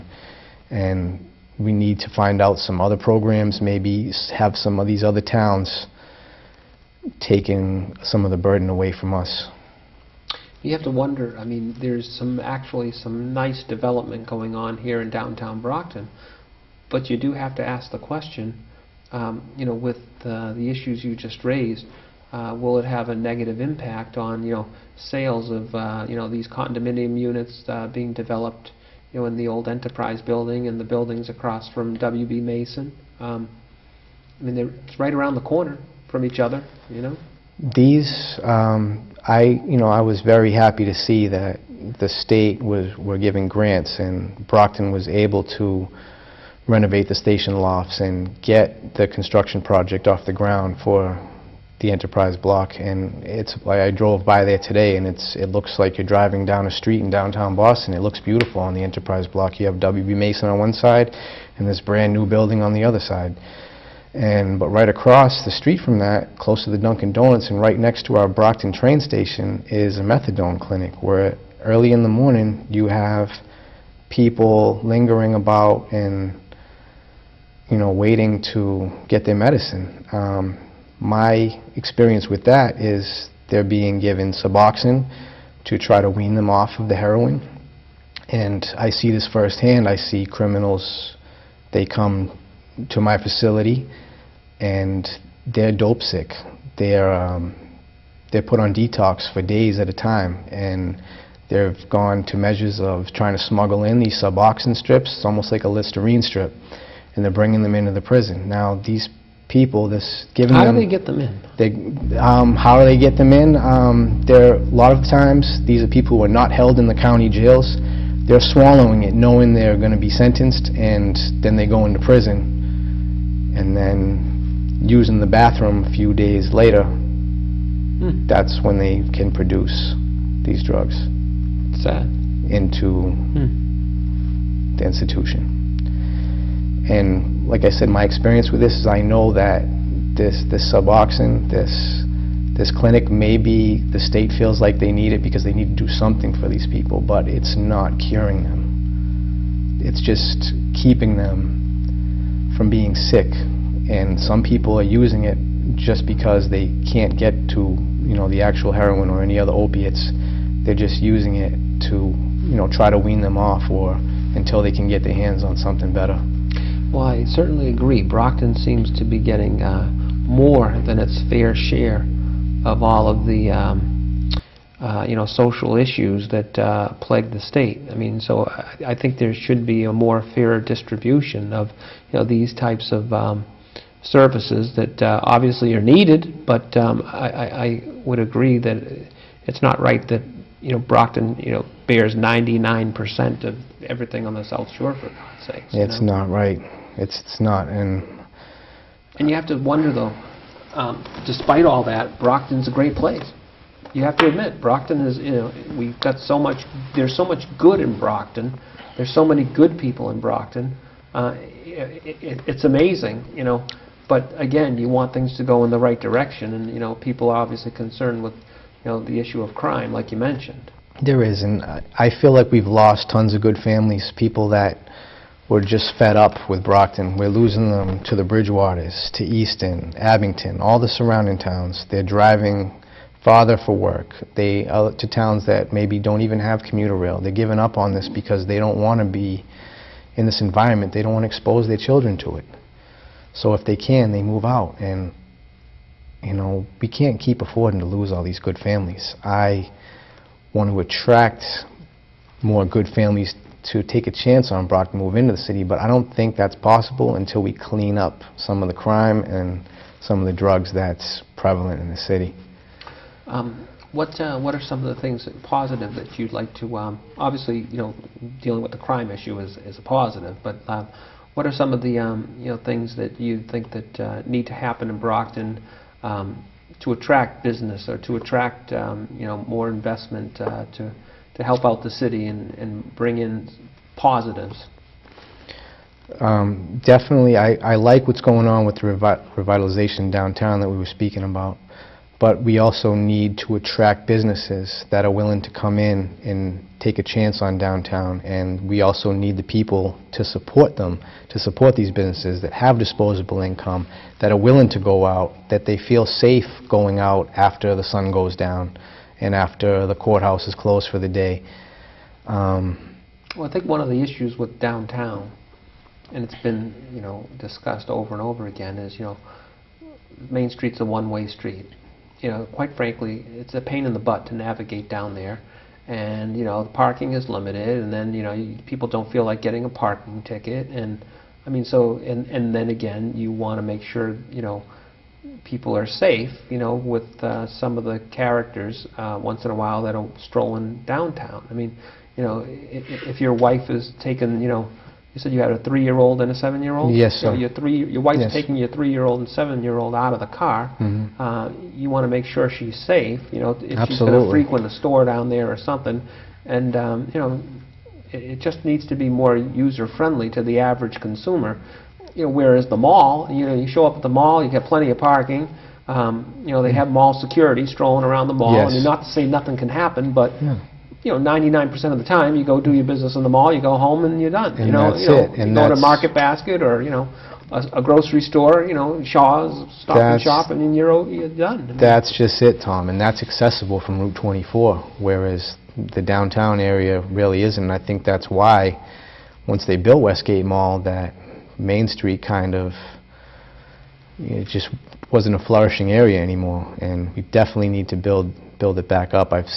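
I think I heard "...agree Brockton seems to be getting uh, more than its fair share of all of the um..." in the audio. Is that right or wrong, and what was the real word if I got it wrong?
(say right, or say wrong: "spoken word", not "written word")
right.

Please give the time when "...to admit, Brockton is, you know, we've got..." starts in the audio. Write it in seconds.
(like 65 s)
204 s.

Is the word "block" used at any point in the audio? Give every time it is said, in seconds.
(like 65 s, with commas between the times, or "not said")
52 s, 59 s.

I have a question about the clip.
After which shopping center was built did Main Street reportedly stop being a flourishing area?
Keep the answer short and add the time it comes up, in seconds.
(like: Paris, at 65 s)
Westgate Mall, at 390 s.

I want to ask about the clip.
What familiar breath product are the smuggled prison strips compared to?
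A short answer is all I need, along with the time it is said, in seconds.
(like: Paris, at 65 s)
Listerine strip, at 105 s.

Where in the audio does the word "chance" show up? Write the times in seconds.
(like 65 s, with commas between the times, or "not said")
254 s, 297 s.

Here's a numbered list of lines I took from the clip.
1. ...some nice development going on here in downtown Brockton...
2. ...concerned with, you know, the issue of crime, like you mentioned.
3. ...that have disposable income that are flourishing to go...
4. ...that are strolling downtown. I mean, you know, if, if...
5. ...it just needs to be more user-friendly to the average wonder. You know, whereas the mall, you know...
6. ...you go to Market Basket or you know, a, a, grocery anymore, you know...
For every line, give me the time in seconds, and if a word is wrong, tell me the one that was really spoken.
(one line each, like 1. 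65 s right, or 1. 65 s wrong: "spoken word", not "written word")
1. 12 s right
2. 217 s right
3. 302 s wrong: "willing", not "flourishing"
4. 339 s right
5. 358 s wrong: "consumer", not "wonder"
6. 375 s wrong: "store", not "anymore".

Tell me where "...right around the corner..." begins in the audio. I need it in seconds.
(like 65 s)
34 s.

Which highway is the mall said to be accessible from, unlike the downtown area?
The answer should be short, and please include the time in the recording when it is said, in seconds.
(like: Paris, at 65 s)
Route 24, at 384 s.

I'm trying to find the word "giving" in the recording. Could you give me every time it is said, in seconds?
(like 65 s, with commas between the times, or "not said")
43 s, 110 s, 237 s.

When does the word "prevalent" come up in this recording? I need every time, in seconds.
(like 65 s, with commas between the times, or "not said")
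261 s.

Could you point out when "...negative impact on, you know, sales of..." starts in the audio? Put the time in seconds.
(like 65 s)
23 s.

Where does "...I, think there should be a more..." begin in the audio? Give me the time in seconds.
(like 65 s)
178 s.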